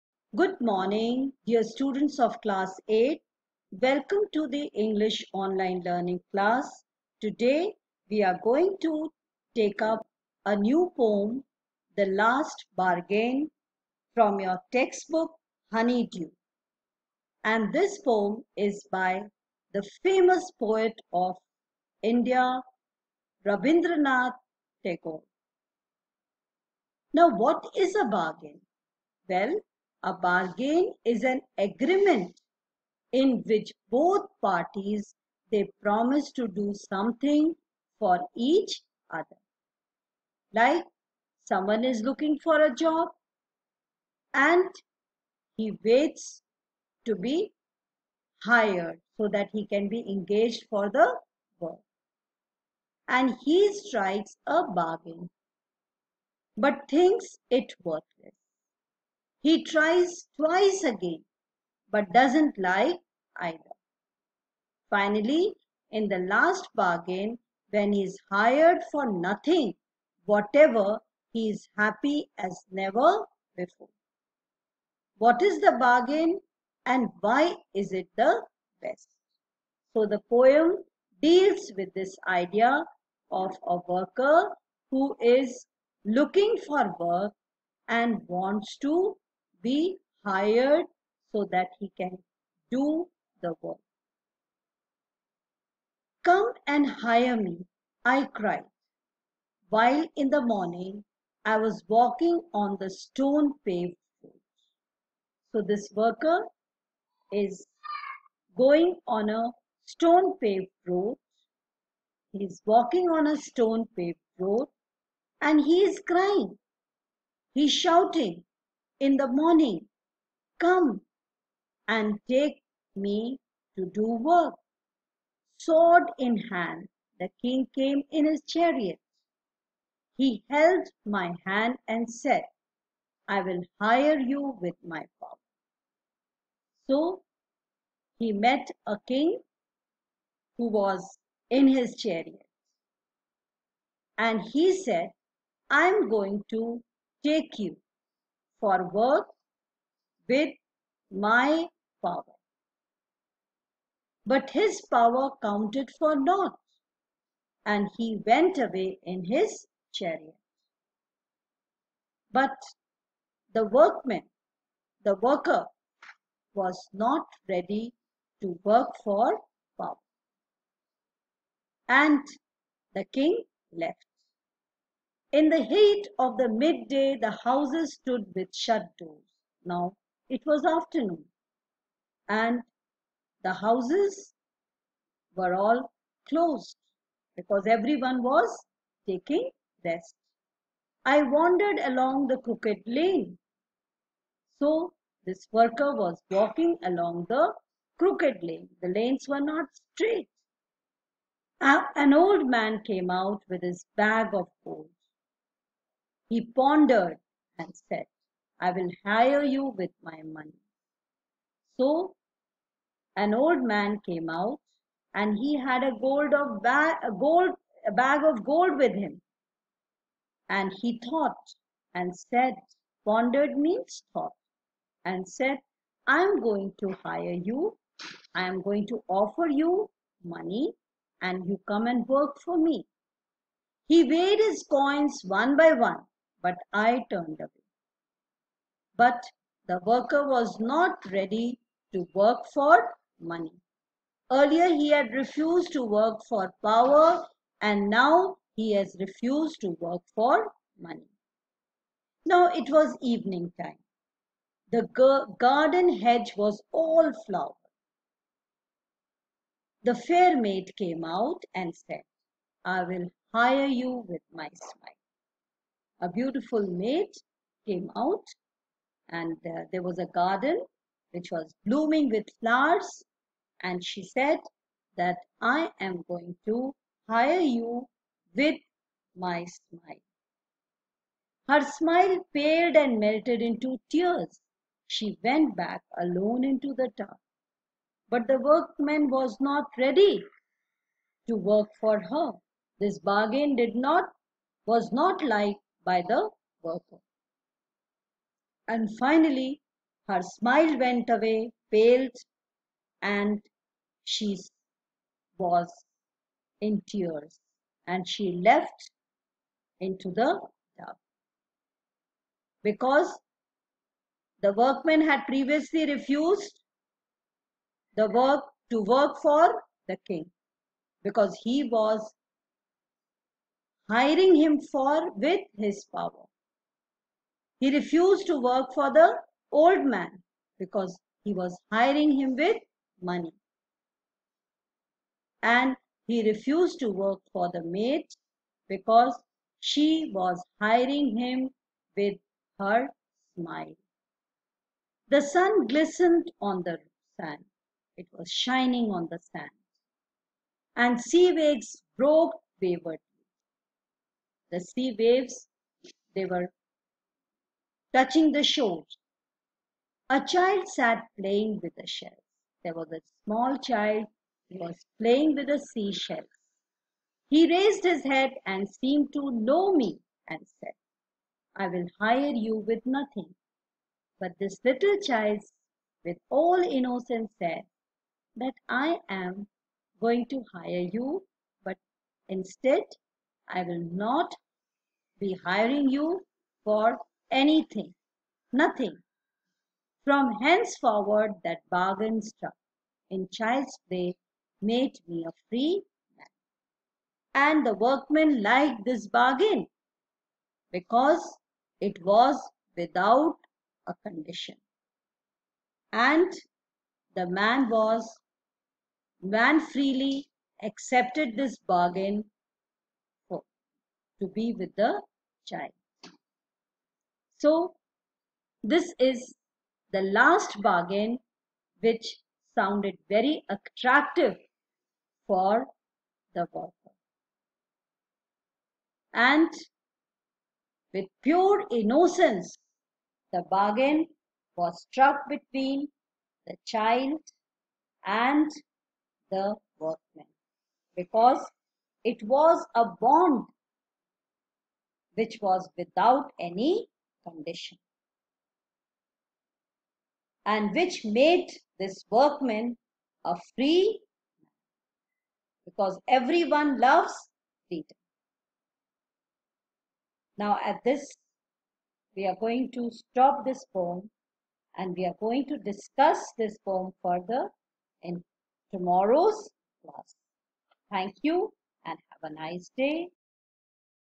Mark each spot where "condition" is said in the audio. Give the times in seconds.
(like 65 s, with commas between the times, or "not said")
404 s, 447 s.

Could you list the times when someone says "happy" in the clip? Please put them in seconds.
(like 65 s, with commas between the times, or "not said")
71 s.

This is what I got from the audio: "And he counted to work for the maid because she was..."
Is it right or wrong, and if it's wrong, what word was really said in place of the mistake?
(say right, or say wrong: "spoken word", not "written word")
wrong: "refused", not "counted".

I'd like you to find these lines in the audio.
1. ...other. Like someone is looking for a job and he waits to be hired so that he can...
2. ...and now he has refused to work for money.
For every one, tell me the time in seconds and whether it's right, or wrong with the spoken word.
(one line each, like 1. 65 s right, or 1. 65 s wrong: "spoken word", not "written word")
1. 39 s right
2. 247 s right.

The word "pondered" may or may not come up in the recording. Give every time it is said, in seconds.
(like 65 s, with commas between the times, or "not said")
206 s, 223 s.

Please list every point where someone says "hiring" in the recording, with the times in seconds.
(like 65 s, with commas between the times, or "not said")
323 s, 331 s, 340 s, 385 s.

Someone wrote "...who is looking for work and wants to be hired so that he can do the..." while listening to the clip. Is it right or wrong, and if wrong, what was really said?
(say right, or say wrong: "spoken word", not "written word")
right.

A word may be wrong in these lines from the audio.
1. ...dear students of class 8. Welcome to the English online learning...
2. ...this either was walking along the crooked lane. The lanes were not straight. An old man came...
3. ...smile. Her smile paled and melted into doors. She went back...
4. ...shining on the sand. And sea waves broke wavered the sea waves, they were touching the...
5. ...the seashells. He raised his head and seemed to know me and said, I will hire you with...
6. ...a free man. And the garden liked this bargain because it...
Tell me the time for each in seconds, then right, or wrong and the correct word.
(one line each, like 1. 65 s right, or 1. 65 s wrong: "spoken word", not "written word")
1. 1 s right
2. 195 s wrong: "worker", not "either"
3. 279 s wrong: "tears", not "doors"
4. 348 s right
5. 365 s right
6. 395 s wrong: "workmen", not "garden".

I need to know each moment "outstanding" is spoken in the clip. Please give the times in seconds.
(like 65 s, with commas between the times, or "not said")
not said.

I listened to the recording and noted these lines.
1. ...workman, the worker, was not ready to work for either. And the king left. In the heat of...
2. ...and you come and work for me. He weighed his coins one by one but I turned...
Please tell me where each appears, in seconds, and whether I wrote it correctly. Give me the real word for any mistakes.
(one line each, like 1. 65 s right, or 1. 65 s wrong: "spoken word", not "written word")
1. 163 s wrong: "power", not "either"
2. 231 s right.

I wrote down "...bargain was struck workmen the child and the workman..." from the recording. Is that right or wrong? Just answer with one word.
wrong.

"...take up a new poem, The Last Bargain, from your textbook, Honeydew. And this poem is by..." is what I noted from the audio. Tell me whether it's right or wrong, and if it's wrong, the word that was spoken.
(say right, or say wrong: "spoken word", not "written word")
right.